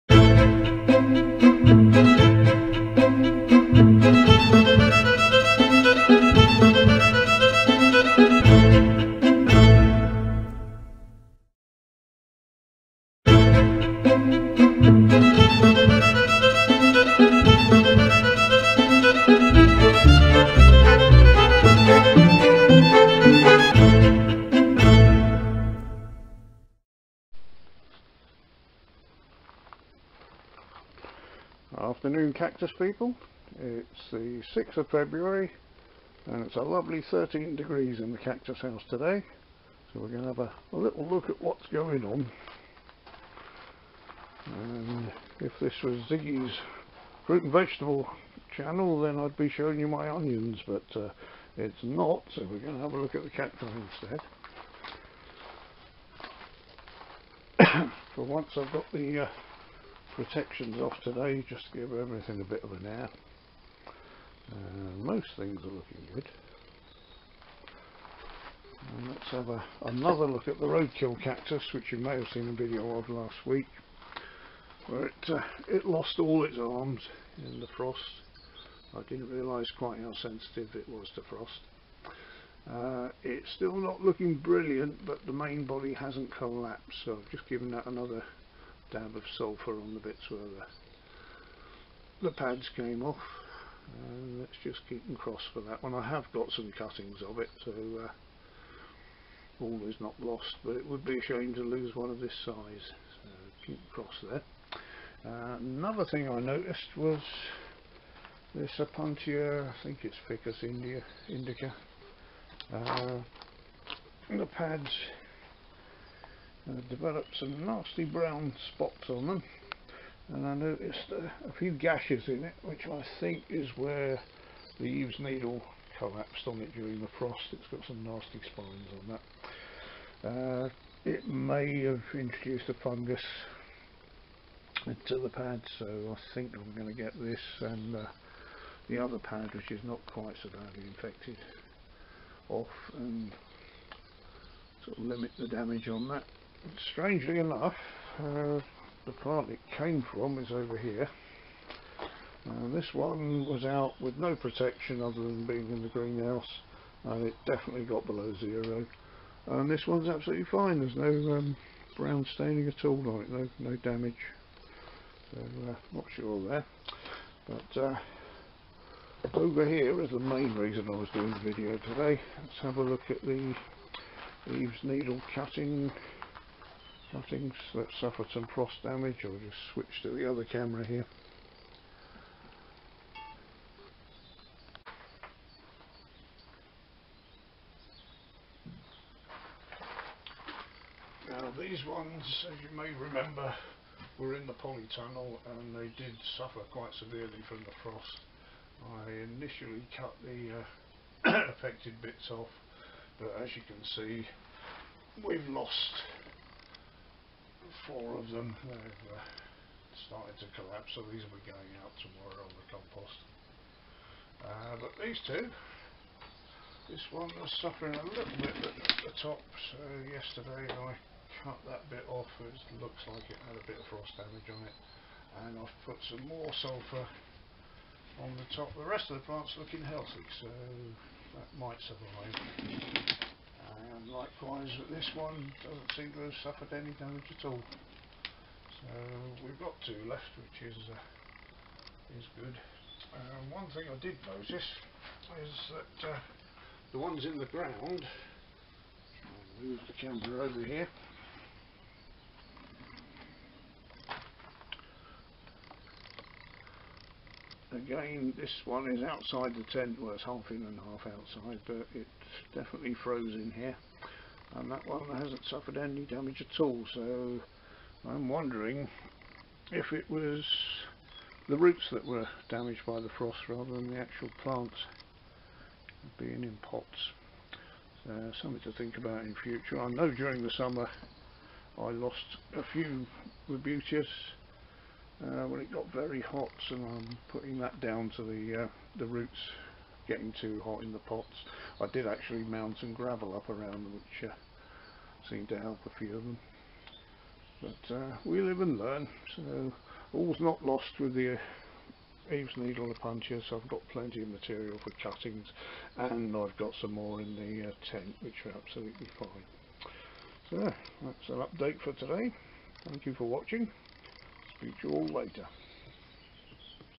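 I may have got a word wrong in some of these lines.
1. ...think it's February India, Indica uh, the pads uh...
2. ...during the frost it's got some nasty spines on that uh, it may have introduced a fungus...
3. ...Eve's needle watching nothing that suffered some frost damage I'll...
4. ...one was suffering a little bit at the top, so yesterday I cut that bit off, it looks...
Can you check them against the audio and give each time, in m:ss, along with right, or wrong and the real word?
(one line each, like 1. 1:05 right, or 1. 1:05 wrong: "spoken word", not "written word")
1. 1:49 wrong: "Ficus", not "February"
2. 2:06 right
3. 2:54 wrong: "cutting", not "watching"
4. 3:37 right.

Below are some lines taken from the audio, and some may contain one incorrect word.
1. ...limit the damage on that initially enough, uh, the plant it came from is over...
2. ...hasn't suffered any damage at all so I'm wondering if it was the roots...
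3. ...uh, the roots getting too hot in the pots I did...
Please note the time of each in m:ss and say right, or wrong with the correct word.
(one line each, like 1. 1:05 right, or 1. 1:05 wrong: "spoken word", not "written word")
1. 2:25 wrong: "strangely", not "initially"
2. 4:25 right
3. 4:48 right.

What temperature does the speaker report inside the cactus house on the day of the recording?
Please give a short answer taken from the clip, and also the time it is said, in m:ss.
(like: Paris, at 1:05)
13 degrees, at 0:37.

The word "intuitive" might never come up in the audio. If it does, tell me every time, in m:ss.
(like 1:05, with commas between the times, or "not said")
not said.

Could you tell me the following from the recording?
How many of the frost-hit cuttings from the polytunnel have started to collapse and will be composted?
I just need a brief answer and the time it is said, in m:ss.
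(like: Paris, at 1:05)
4, at 3:27.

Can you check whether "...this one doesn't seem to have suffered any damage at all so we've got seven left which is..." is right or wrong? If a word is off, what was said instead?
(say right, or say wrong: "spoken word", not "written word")
wrong: "two", not "seven".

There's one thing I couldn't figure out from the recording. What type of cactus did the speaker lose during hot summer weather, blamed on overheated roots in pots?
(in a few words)
Rebutias.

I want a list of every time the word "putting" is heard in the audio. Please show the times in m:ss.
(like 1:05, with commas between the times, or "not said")
4:47.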